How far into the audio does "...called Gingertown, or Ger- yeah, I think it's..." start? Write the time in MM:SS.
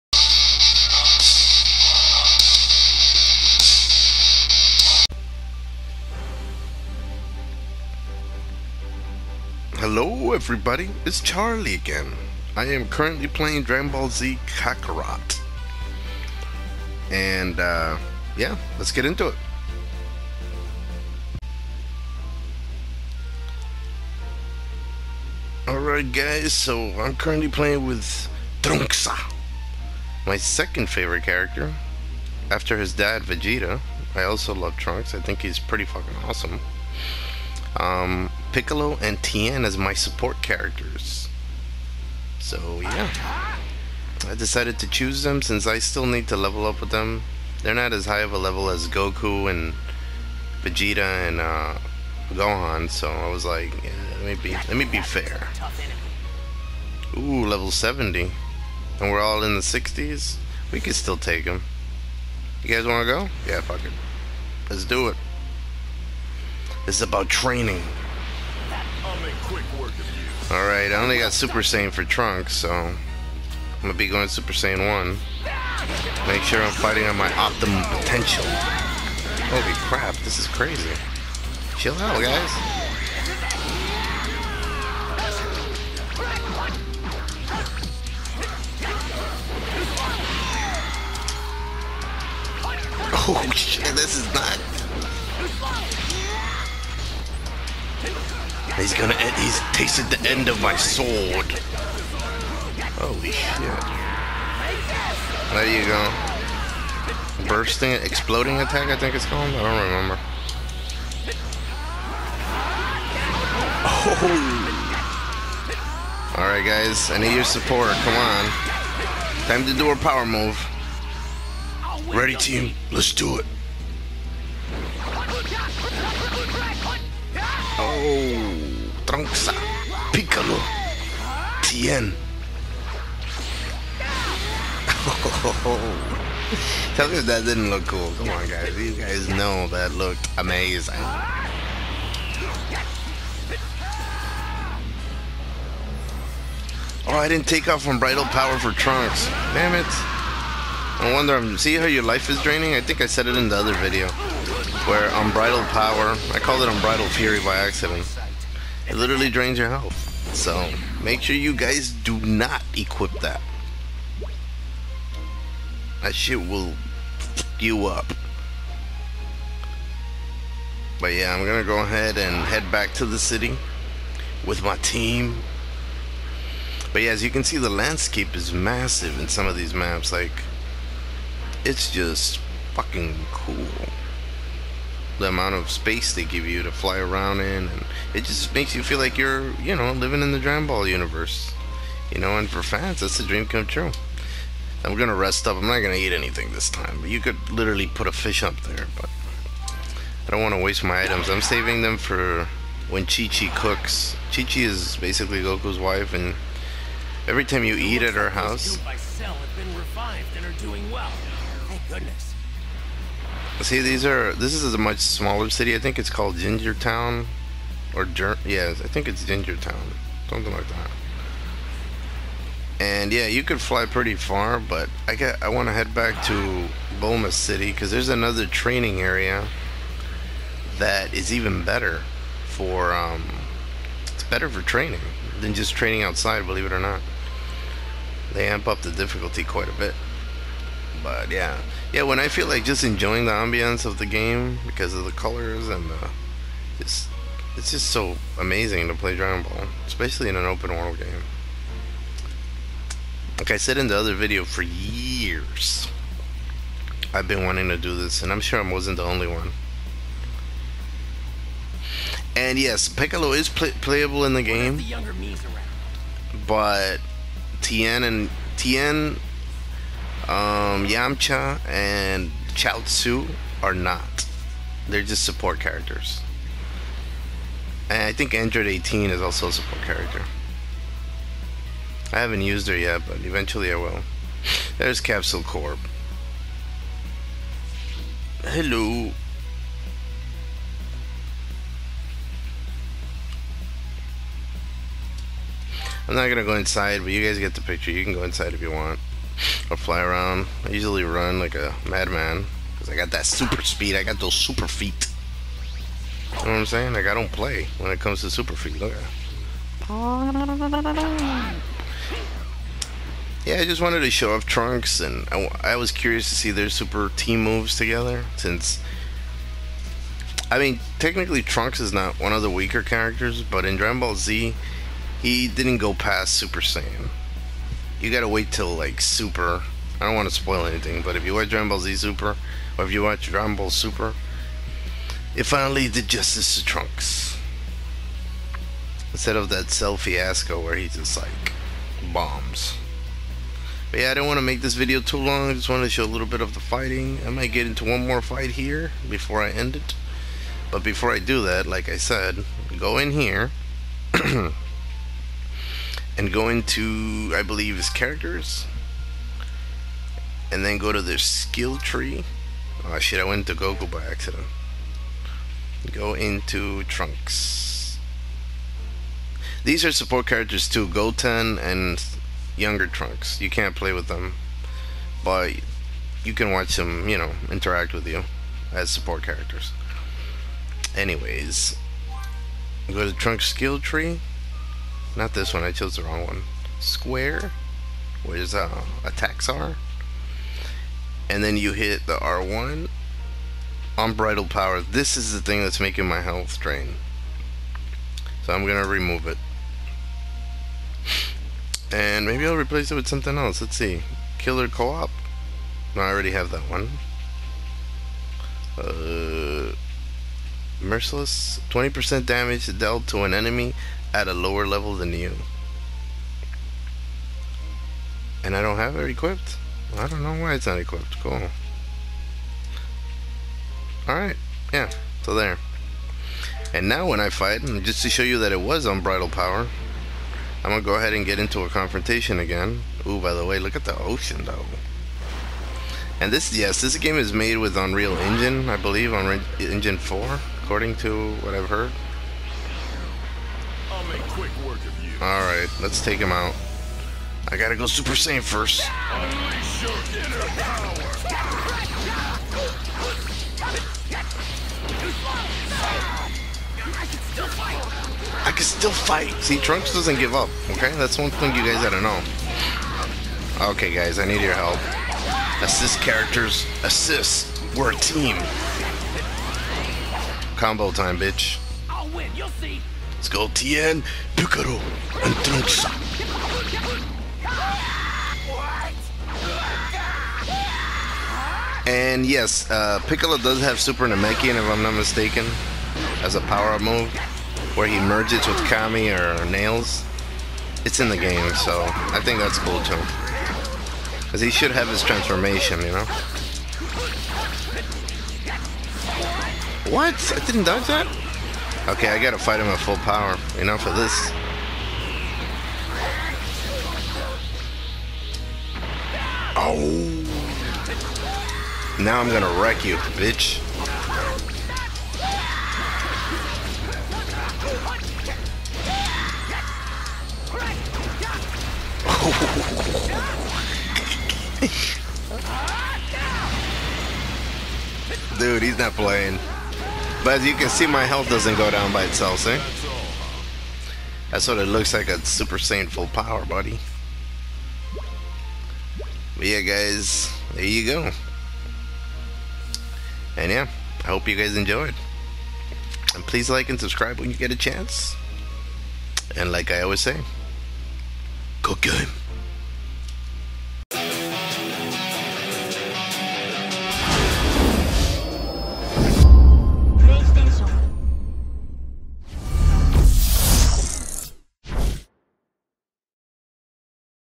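03:36.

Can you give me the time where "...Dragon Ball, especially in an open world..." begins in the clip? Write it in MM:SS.
04:09.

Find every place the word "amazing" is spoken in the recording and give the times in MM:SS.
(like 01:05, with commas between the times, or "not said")
02:20, 04:08.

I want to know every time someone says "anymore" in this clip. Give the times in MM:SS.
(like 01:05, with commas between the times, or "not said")
not said.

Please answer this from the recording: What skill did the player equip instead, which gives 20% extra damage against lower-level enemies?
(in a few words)
Merciless.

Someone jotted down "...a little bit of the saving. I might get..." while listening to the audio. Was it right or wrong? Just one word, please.
wrong.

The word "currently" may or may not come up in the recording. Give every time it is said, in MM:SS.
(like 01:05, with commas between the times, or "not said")
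00:12, 00:27.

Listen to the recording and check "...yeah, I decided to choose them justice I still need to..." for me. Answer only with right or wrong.
wrong.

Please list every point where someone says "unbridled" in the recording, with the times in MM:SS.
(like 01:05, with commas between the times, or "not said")
02:27, 06:33, 07:08.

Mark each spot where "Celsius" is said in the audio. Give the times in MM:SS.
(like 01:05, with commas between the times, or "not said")
not said.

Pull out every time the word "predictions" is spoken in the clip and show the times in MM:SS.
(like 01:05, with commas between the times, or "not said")
not said.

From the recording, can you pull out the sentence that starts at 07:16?
And this, yes, this game is made with Unreal Engine, I believe, on Engine 4 according to what I've heard.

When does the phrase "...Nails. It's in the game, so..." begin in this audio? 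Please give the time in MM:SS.
08:09.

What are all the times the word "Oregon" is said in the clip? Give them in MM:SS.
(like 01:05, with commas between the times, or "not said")
not said.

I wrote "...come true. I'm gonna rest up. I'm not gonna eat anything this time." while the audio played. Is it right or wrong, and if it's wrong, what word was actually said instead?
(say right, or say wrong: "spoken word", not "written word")
right.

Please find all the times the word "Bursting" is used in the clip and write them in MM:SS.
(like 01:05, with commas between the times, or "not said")
01:47.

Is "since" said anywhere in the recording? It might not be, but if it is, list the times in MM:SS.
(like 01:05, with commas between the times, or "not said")
00:45, 05:18.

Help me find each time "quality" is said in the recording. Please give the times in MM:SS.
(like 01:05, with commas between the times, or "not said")
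not said.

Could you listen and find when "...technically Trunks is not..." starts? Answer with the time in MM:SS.
05:20.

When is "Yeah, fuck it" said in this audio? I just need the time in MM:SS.
01:03.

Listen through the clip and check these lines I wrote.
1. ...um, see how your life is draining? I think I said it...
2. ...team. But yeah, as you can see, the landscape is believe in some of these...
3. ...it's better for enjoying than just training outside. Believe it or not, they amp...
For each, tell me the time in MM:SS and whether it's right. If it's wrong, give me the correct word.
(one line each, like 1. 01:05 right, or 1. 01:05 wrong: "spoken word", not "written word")
1. 02:31 right
2. 02:54 wrong: "massive", not "believe"
3. 03:54 wrong: "training", not "enjoying".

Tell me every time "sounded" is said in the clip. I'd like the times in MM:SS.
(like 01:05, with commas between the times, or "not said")
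not said.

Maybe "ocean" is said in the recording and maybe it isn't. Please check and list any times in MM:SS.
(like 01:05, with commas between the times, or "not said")
07:13.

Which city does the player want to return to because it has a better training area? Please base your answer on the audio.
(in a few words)
Boma City.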